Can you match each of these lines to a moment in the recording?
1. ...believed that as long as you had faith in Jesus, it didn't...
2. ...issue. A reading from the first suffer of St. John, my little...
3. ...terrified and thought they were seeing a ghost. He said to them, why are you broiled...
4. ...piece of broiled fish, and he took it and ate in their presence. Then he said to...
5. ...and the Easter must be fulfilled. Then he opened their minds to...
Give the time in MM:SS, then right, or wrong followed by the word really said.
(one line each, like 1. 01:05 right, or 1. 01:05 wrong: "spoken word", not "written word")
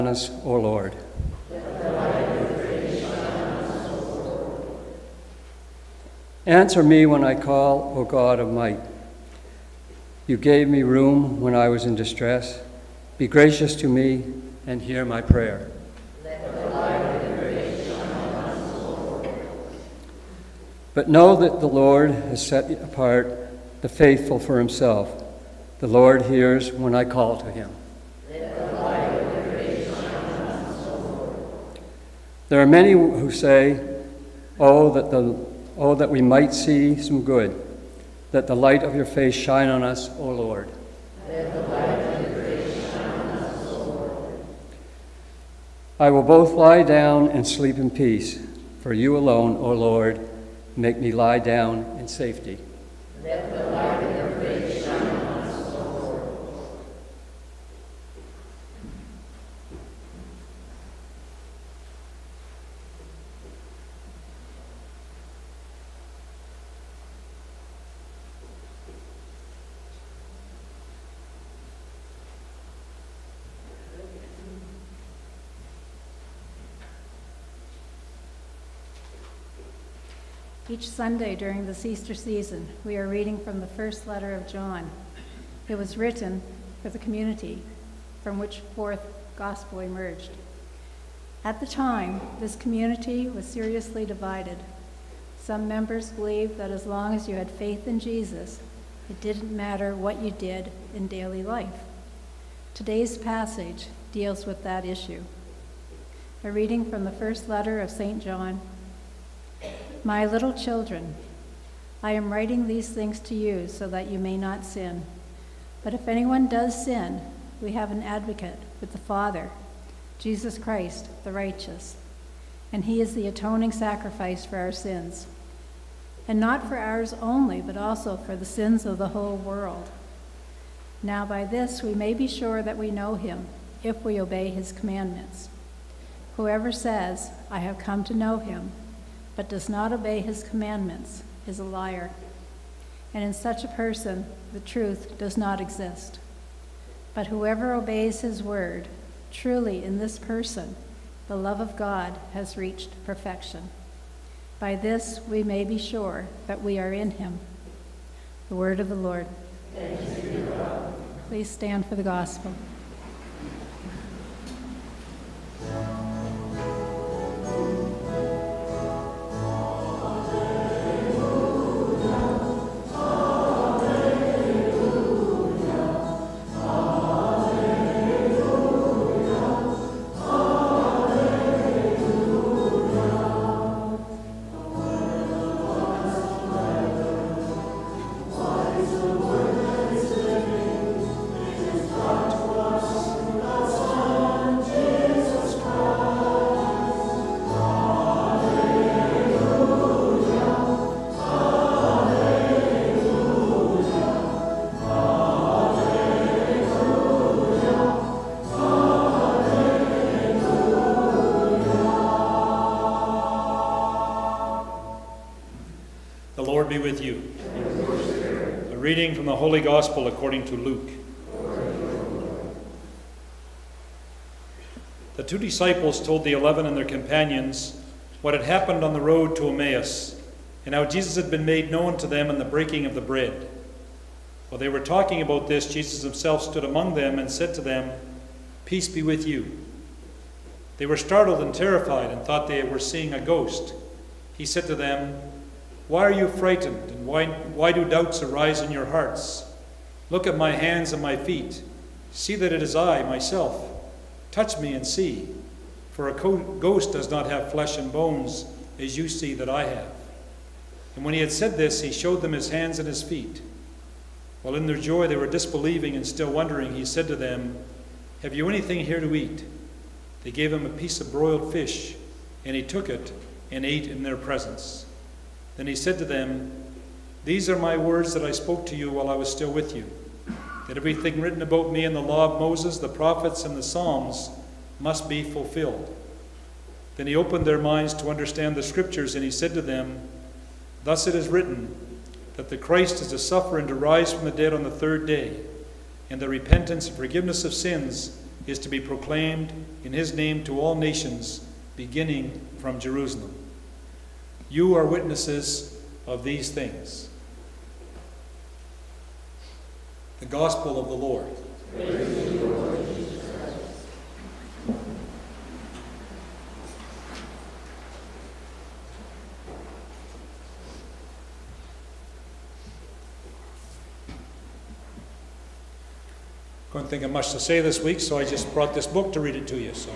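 1. 01:36 right
2. 01:44 wrong: "letter", not "suffer"
3. 04:01 wrong: "frightened", not "broiled"
4. 04:30 right
5. 04:43 wrong: "Psalms", not "Easter".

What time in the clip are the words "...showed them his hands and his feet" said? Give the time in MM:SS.
04:21.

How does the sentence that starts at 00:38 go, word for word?
That the light of your face shine on us, O Lord.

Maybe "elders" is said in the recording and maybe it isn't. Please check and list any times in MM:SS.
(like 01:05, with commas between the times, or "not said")
not said.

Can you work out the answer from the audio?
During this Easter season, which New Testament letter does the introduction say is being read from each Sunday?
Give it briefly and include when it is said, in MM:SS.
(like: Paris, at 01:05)
First letter of John, at 01:23.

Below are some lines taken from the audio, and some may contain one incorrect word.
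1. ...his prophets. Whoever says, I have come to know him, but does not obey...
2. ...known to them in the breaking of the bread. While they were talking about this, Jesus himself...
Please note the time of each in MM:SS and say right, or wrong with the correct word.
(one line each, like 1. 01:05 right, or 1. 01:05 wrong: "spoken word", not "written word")
1. 02:14 wrong: "commandments", not "prophets"
2. 03:51 right.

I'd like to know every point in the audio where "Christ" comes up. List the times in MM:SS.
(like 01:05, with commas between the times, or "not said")
02:00, 04:52.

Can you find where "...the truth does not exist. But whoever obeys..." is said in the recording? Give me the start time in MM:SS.
02:24.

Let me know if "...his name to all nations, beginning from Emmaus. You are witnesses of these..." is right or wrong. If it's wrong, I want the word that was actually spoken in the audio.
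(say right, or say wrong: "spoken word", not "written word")
wrong: "Jerusalem", not "Emmaus".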